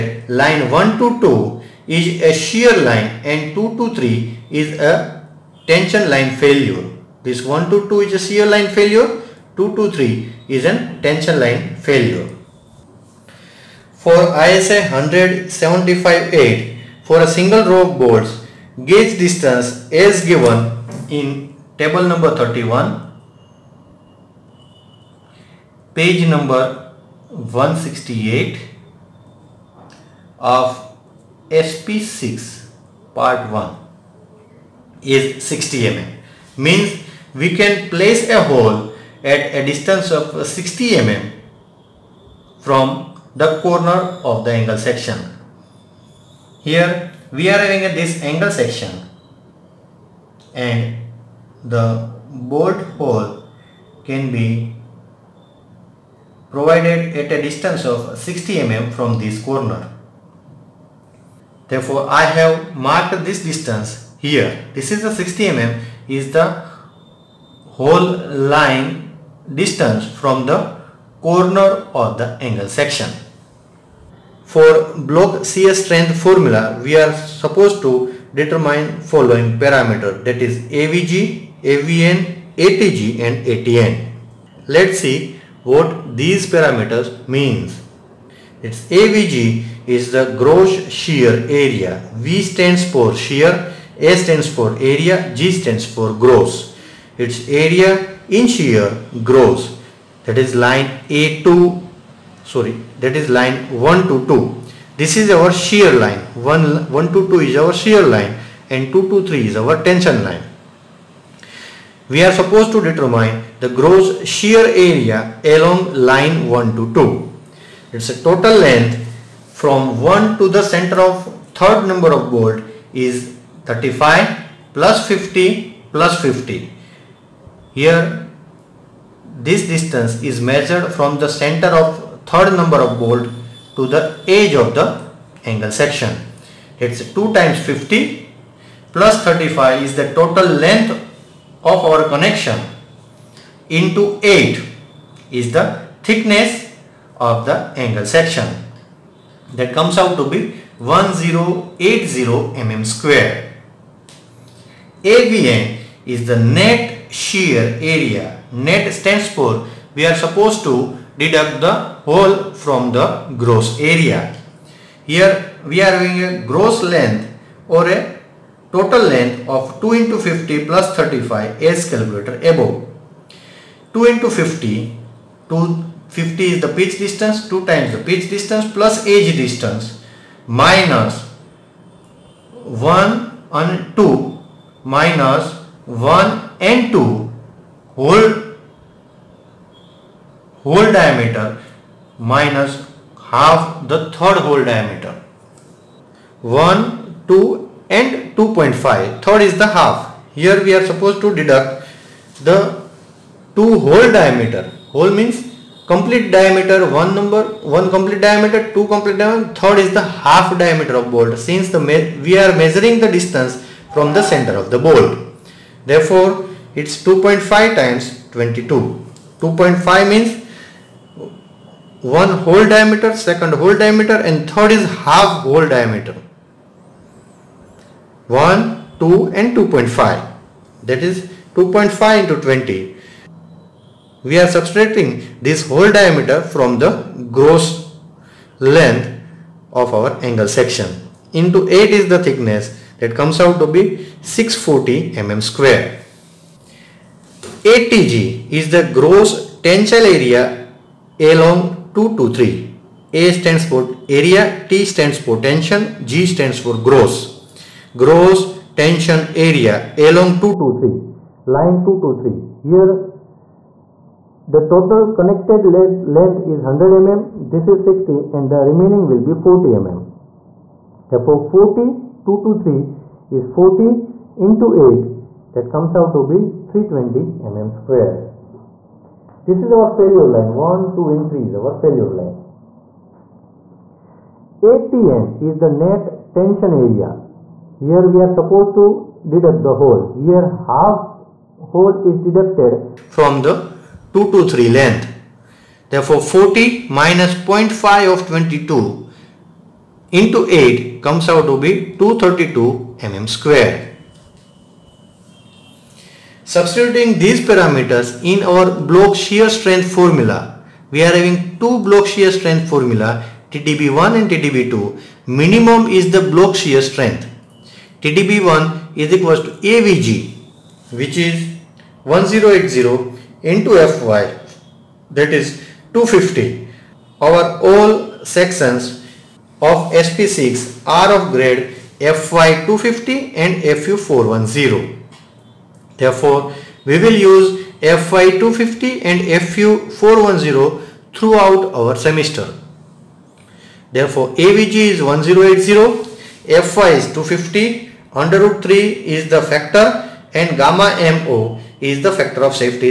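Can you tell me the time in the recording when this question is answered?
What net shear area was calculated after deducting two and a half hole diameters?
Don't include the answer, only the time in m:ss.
4:04.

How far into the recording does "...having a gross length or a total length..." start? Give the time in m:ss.
2:45.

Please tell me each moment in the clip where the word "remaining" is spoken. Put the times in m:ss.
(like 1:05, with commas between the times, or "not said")
4:28.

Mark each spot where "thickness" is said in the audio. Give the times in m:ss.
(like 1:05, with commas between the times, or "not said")
2:26, 4:02.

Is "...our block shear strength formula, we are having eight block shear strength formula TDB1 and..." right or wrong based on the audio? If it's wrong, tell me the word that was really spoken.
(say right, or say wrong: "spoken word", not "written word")
wrong: "two", not "eight".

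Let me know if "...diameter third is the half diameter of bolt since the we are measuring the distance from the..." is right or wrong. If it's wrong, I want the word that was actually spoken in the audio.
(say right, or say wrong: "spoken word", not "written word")
right.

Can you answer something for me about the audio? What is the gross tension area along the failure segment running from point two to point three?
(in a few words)
320 mm square.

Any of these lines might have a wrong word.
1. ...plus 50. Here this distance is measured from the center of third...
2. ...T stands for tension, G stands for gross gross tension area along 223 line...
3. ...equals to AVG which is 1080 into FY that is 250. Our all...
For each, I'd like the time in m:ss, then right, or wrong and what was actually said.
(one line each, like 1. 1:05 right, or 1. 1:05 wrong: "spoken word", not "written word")
1. 2:05 right
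2. 4:14 right
3. 5:19 right.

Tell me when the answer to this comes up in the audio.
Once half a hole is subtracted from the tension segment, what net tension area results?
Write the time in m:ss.
5:01.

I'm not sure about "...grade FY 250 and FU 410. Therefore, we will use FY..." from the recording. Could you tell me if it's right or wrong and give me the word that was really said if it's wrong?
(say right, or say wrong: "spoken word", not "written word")
right.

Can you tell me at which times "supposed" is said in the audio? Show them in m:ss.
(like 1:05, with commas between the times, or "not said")
1:17, 1:52, 2:40, 3:20, 4:48.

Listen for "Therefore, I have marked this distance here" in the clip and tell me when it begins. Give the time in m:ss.
1:01.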